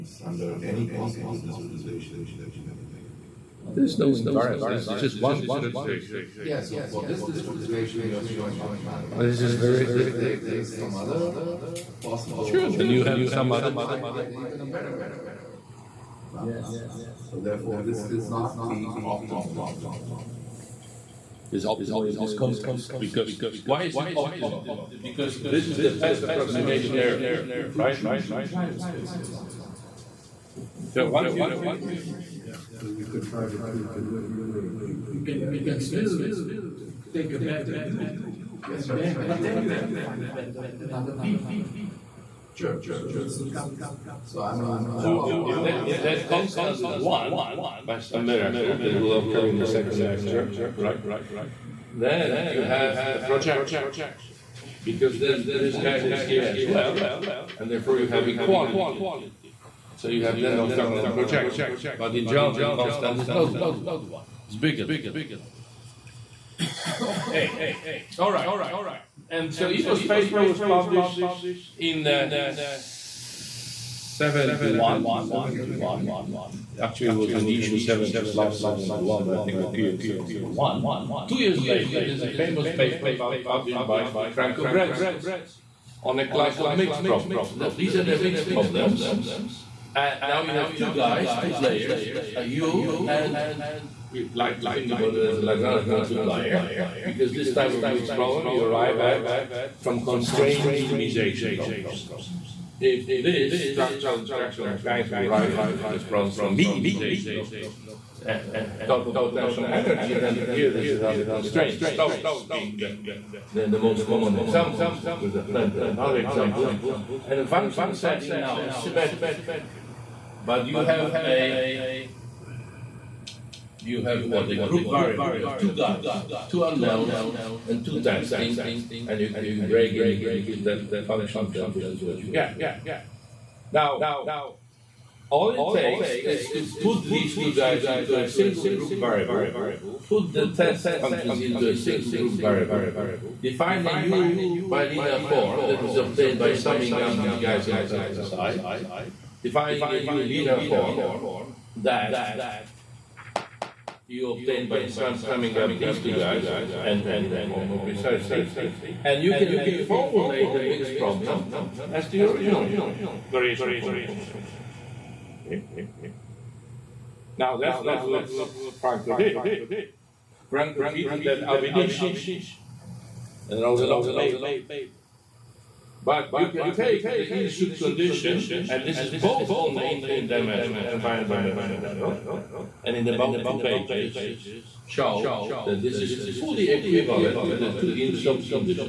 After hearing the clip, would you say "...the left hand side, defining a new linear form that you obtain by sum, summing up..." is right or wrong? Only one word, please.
right.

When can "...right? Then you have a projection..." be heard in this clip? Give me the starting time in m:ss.
0:50.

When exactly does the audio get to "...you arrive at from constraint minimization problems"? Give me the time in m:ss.
1:38.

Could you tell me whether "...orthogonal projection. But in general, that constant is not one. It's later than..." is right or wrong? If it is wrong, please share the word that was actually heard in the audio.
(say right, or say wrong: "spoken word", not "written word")
wrong: "bigger", not "later".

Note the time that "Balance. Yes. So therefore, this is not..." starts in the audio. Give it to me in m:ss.
0:16.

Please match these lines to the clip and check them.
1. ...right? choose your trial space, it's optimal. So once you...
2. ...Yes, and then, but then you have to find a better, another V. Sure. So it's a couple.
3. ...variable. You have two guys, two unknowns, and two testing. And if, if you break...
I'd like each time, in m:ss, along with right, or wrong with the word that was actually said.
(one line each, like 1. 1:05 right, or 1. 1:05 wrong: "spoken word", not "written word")
1. 0:27 right
2. 0:38 right
3. 2:04 right.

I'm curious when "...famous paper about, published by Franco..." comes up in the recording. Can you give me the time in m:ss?
1:22.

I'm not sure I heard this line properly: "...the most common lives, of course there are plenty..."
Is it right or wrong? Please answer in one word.
wrong.